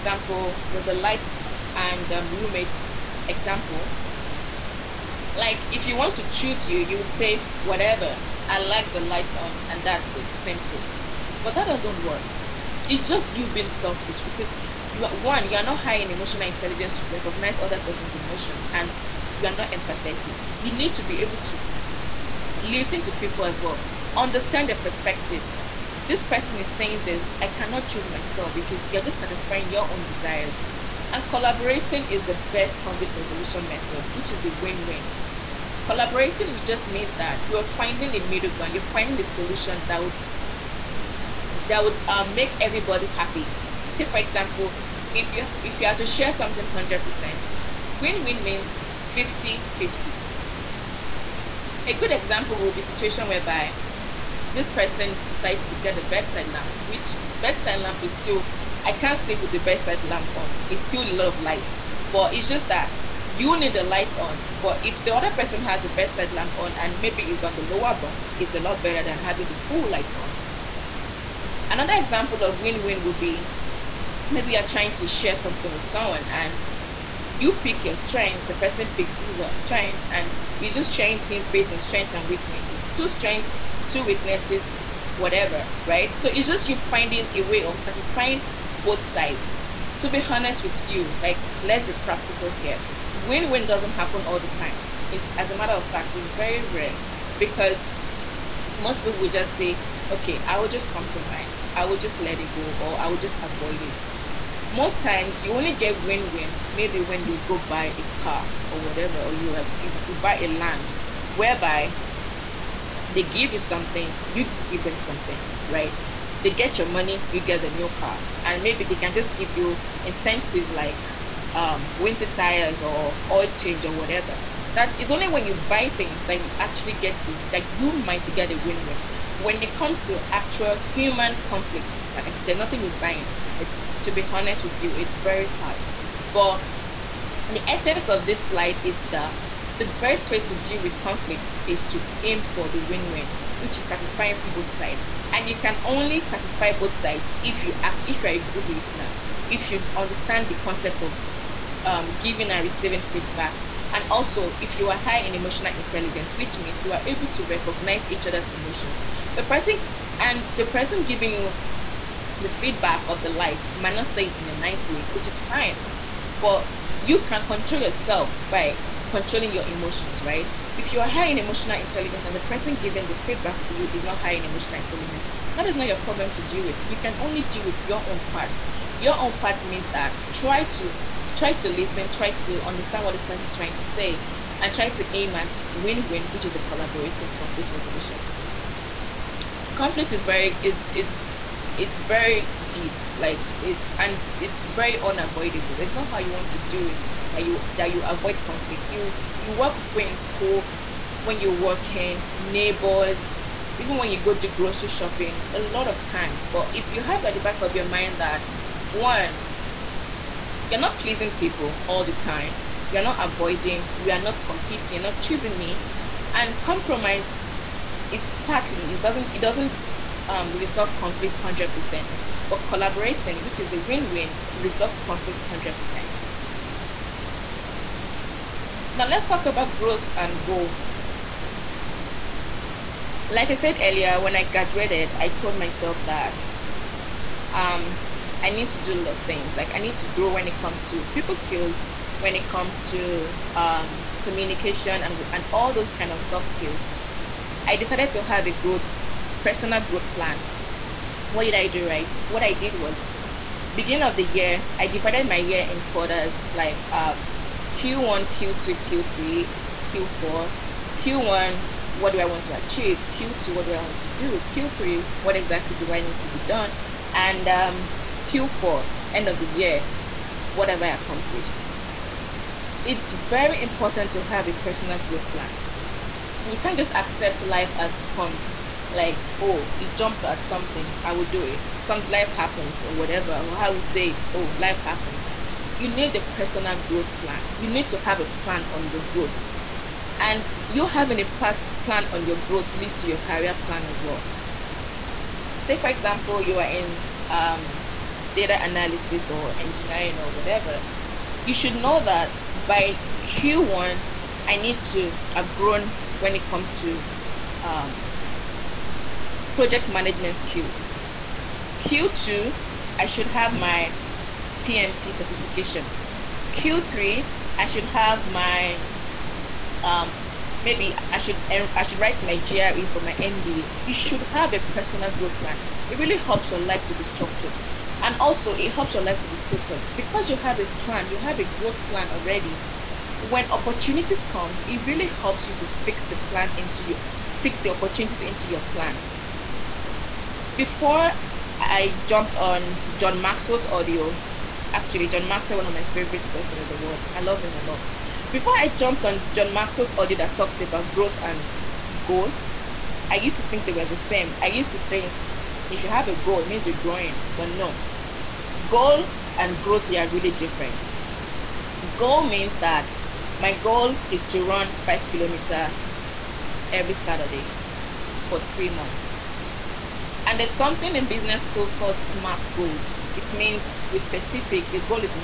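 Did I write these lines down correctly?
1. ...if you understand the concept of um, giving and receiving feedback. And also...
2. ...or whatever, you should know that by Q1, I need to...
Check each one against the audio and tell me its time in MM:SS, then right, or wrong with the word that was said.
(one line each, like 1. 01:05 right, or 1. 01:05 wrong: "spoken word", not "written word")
1. 02:29 right
2. 05:00 right.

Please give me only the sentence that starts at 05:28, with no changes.
And also, it helps your life to be focused because you have a plan, you have a growth plan already.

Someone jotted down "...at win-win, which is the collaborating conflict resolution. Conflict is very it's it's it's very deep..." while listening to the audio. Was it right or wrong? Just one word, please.
right.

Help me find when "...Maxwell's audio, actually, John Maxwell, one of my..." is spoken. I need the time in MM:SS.
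05:43.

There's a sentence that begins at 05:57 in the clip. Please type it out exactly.
But no, Goal and growth they are really different.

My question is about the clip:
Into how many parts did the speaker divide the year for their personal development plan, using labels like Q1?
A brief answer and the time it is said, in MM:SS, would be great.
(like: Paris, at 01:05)
4, at 04:15.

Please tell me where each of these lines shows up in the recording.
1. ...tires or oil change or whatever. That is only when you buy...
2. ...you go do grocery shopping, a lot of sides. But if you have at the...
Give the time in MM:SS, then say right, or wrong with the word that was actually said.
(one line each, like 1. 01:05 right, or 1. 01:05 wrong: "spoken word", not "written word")
1. 02:02 right
2. 03:24 wrong: "times", not "sides".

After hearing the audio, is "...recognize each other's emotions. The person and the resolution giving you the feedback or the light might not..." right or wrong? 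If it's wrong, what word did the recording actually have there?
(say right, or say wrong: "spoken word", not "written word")
wrong: "person", not "resolution".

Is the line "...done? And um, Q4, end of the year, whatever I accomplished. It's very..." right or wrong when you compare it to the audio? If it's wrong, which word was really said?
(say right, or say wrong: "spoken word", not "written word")
right.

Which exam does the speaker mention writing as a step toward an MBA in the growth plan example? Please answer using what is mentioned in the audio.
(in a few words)
GRE.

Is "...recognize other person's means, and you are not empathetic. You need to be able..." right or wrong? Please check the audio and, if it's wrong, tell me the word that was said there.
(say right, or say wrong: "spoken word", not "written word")
wrong: "emotions", not "means".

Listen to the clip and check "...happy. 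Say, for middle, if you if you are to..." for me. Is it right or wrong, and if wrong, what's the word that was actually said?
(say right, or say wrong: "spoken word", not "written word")
wrong: "example", not "middle".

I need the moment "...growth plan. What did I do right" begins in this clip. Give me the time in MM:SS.
04:09.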